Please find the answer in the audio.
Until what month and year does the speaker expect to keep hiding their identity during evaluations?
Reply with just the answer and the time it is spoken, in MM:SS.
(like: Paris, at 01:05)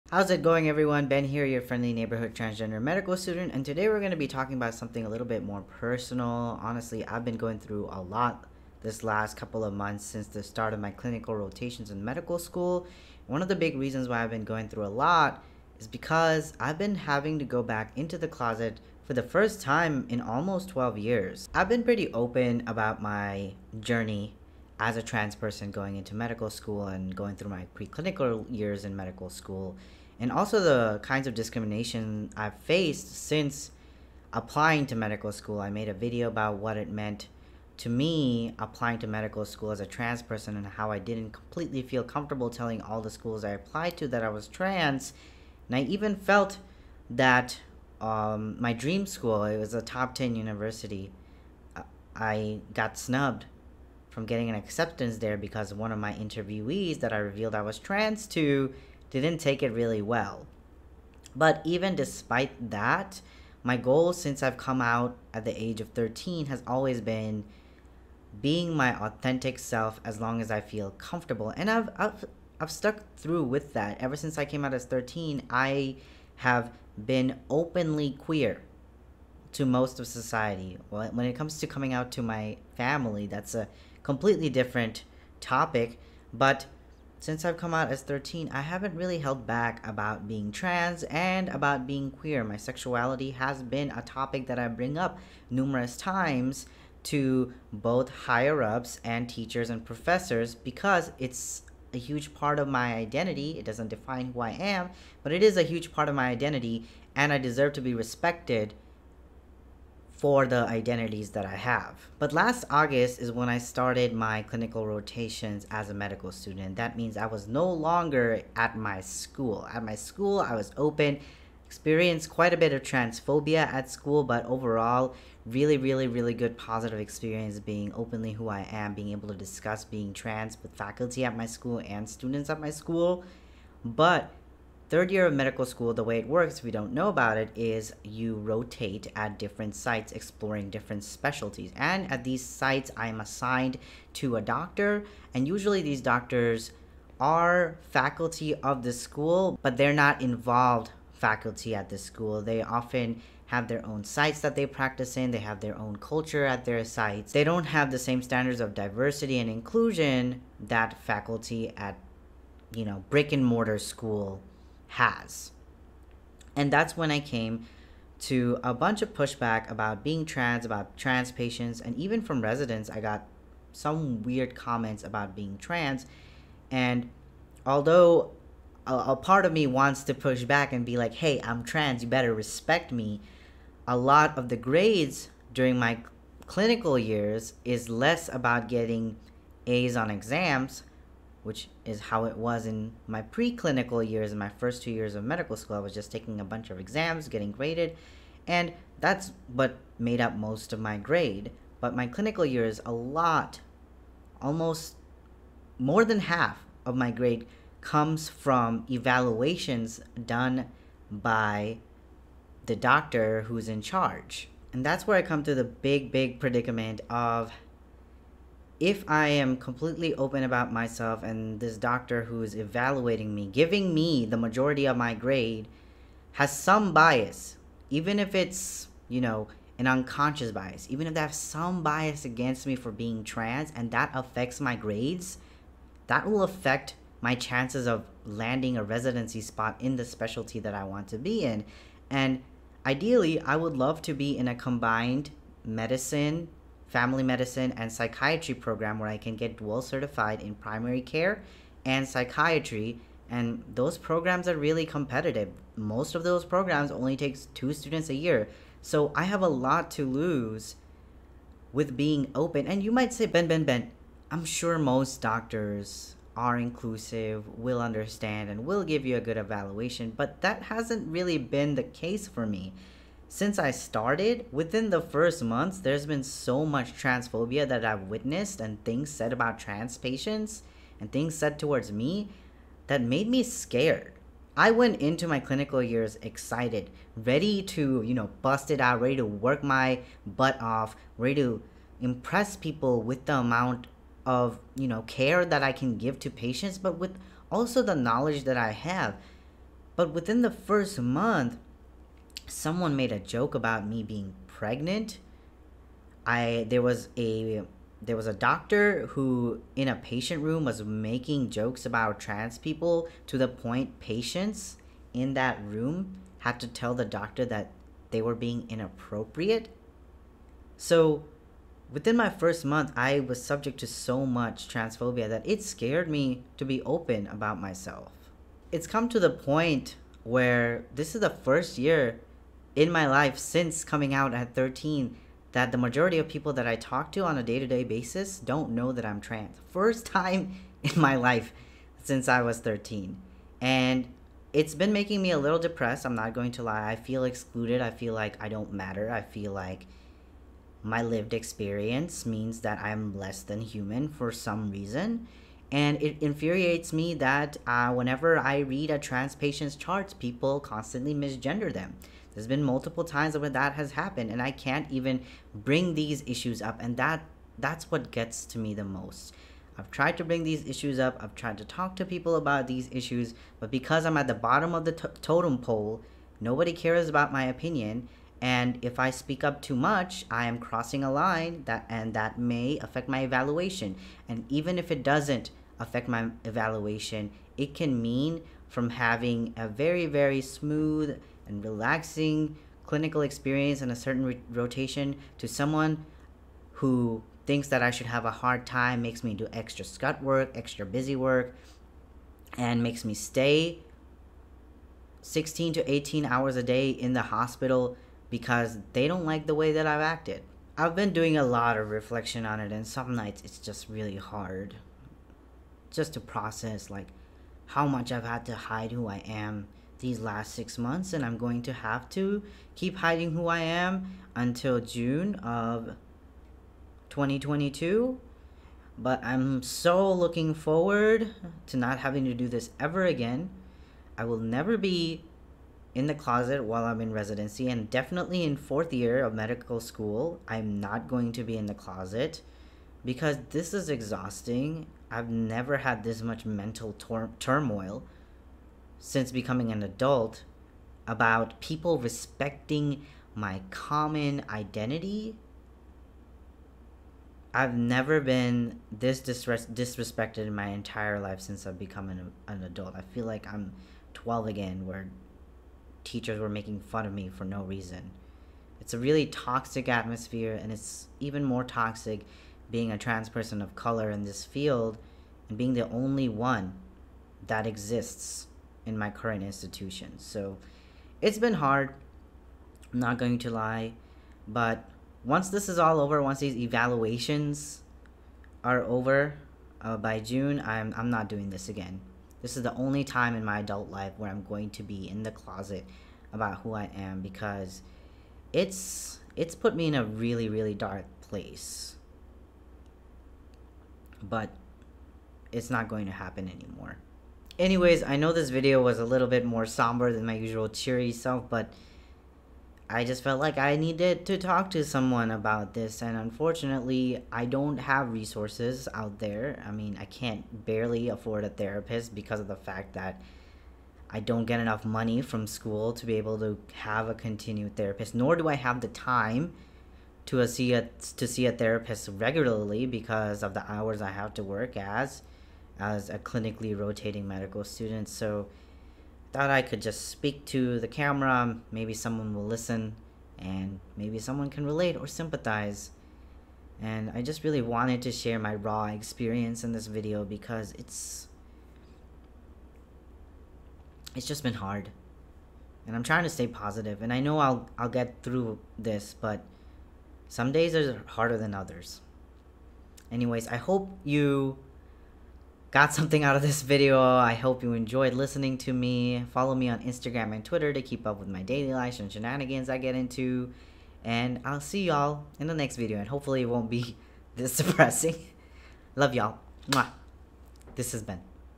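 June 2022, at 07:04.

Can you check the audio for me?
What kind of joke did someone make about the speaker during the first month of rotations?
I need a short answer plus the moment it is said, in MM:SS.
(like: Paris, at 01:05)
being pregnant, at 05:04.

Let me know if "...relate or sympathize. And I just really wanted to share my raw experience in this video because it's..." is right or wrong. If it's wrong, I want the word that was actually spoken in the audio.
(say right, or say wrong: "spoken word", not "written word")
right.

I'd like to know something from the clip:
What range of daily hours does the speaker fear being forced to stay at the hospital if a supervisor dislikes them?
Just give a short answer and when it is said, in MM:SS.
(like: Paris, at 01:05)
16 to 18 hours, at 06:45.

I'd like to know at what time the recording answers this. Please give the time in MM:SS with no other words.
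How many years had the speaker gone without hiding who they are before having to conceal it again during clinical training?
00:20.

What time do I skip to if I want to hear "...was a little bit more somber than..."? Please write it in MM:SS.
08:28.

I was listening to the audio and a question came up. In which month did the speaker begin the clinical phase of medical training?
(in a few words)
August.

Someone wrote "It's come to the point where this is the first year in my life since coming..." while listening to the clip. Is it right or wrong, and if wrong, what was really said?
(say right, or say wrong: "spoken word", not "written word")
right.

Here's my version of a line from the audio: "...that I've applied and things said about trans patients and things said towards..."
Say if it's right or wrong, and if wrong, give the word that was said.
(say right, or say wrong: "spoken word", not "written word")
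wrong: "witnessed", not "applied".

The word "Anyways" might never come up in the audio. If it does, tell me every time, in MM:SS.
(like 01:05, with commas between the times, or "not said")
08:27, 09:23.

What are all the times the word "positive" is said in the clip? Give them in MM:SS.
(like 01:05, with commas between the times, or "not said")
02:06, 09:16.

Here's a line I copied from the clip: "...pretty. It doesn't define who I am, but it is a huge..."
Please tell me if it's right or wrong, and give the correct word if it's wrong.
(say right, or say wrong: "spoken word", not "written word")
wrong: "identity", not "pretty".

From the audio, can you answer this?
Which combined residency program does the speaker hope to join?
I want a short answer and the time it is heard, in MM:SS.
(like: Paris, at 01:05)
medicine family medicine and psychiatry, at 04:05.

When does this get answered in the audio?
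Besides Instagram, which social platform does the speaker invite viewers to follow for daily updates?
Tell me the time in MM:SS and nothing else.
09:30.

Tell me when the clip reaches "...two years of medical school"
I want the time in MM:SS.
03:14.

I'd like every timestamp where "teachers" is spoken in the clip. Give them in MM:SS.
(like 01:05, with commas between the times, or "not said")
01:39, 07:46.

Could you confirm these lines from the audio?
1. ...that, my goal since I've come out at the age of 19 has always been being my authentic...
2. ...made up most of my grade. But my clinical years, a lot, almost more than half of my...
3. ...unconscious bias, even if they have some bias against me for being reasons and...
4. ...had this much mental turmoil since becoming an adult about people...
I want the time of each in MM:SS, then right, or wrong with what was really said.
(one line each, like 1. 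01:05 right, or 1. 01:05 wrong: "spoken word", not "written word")
1. 01:02 wrong: "13", not "19"
2. 03:19 right
3. 03:49 wrong: "trans", not "reasons"
4. 07:25 right.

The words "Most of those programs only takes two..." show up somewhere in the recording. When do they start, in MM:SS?
04:15.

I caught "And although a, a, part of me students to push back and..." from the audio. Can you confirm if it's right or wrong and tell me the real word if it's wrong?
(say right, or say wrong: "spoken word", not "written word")
wrong: "wants", not "students".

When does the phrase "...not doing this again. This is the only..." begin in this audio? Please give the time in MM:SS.
08:11.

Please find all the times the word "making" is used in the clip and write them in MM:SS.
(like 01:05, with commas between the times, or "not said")
05:10, 05:44, 07:46.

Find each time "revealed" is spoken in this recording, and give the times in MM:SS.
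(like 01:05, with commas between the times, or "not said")
00:57.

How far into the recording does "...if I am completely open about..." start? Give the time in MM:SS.
03:38.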